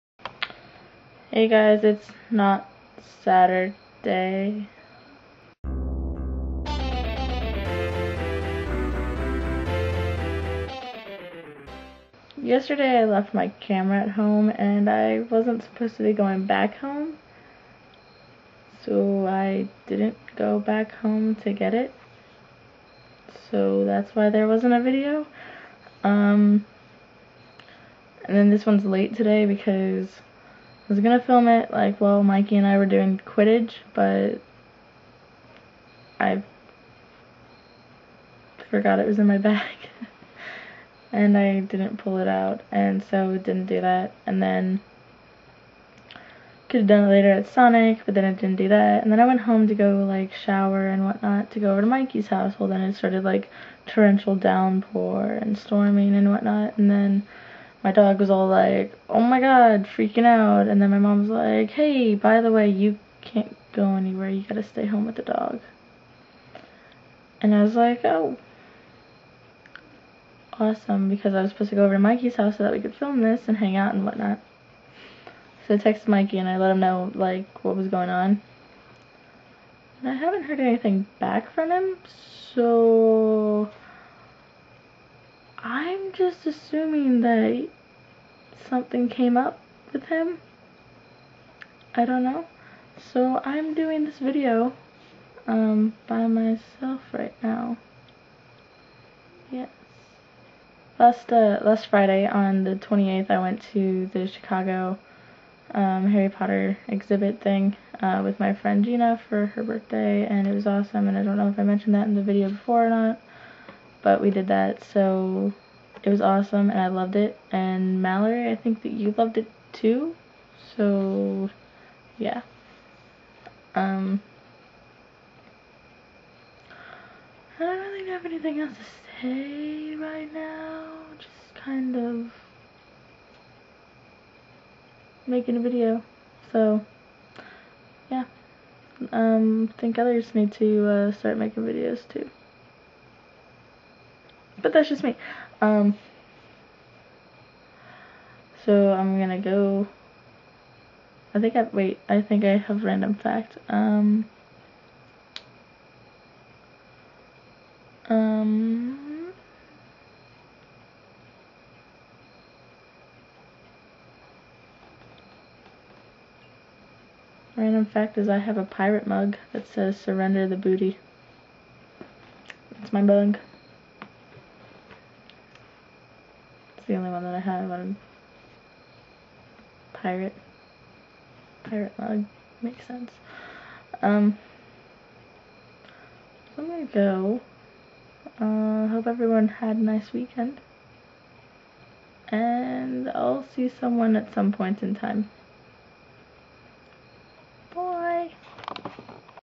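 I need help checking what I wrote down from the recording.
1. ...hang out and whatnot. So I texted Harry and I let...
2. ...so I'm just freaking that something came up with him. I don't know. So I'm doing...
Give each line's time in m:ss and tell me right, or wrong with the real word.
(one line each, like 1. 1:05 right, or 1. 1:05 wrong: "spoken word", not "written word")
1. 1:13 wrong: "Mikey", not "Harry"
2. 1:22 wrong: "assuming", not "freaking".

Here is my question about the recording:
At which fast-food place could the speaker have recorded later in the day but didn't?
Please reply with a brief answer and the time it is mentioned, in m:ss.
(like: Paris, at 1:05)
Sonic, at 0:47.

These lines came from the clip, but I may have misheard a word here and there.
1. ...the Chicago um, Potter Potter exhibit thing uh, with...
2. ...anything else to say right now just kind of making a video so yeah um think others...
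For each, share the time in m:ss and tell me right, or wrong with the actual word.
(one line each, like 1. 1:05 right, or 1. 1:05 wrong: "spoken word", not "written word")
1. 1:44 wrong: "Harry", not "Potter"
2. 2:08 right.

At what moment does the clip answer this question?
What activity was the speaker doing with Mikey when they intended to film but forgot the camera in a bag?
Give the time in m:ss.
0:33.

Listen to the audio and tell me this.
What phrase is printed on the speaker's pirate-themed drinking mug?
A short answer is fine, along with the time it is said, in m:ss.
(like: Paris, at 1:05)
Surrender the booty, at 2:49.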